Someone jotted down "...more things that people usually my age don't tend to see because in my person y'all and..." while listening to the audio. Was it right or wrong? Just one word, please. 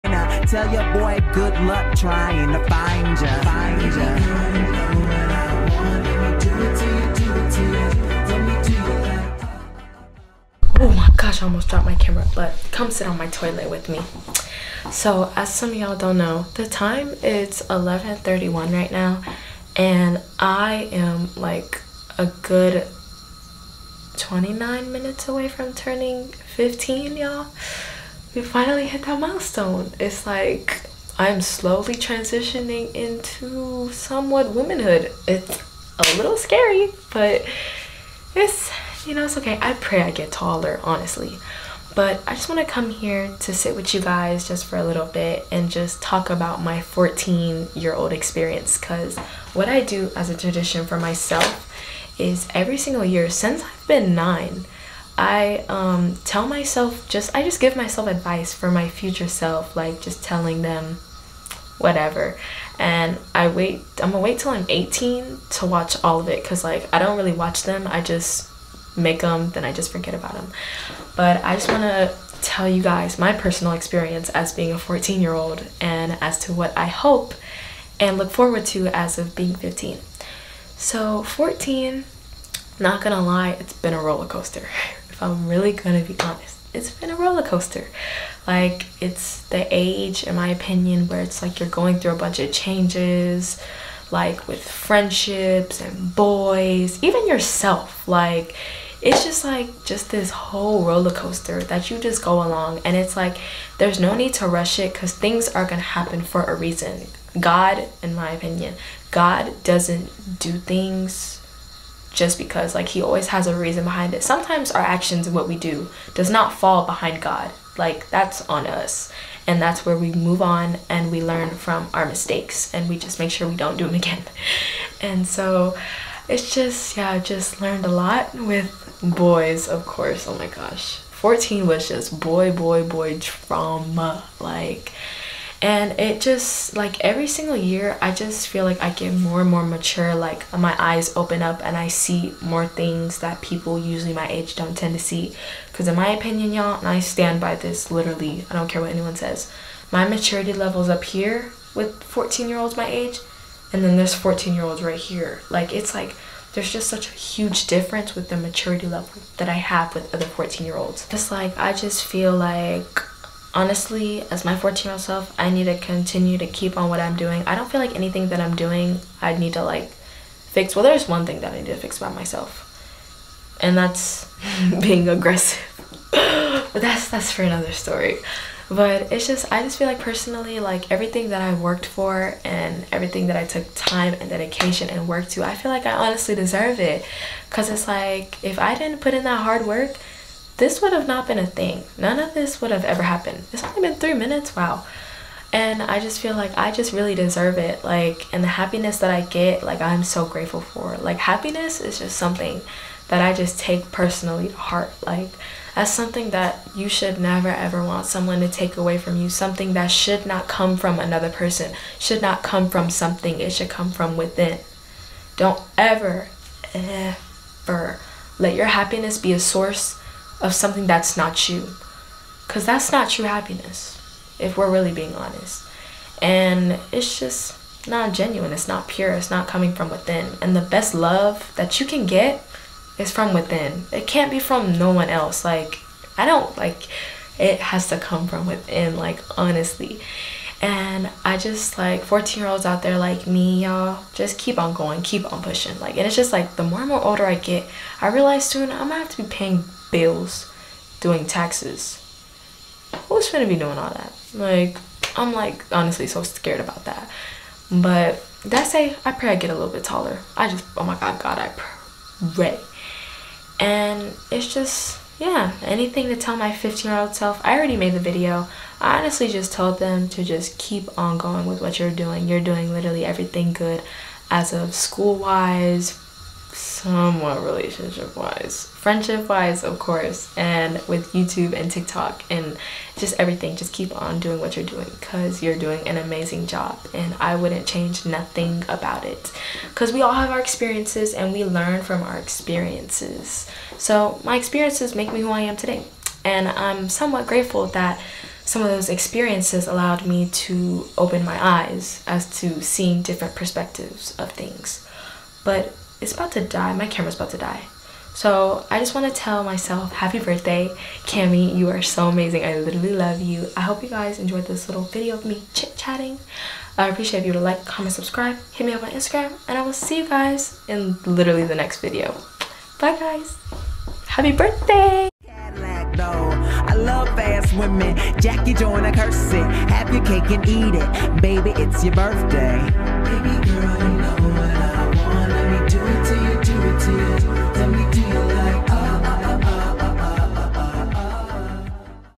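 wrong.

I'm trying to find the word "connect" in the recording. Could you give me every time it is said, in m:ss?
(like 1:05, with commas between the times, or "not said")
not said.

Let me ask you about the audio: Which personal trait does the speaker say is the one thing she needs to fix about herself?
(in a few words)
being aggressive.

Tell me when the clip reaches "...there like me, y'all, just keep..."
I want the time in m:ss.
4:02.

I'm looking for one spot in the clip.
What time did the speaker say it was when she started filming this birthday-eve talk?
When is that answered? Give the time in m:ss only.
0:17.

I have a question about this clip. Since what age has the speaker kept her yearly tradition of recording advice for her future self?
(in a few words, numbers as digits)
nine.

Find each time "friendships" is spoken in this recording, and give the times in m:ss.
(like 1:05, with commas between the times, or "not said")
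1:34, 4:38.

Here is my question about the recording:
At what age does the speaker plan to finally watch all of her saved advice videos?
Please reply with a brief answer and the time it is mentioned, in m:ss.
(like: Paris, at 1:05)
18, at 1:04.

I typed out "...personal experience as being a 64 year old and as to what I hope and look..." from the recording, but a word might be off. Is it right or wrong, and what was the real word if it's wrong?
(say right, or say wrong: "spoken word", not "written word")
wrong: "14", not "64".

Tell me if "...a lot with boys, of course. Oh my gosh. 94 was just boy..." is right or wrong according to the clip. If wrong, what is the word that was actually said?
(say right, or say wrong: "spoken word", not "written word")
wrong: "14", not "94".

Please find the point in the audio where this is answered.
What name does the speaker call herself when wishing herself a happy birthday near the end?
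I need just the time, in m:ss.
5:11.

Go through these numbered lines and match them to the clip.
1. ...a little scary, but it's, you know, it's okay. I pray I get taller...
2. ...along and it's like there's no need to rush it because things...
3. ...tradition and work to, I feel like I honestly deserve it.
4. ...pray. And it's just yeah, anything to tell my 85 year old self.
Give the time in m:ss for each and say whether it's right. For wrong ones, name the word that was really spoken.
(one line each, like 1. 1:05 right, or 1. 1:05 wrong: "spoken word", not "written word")
1. 0:35 right
2. 1:42 right
3. 3:04 wrong: "dedication", not "tradition"
4. 4:22 wrong: "15", not "85".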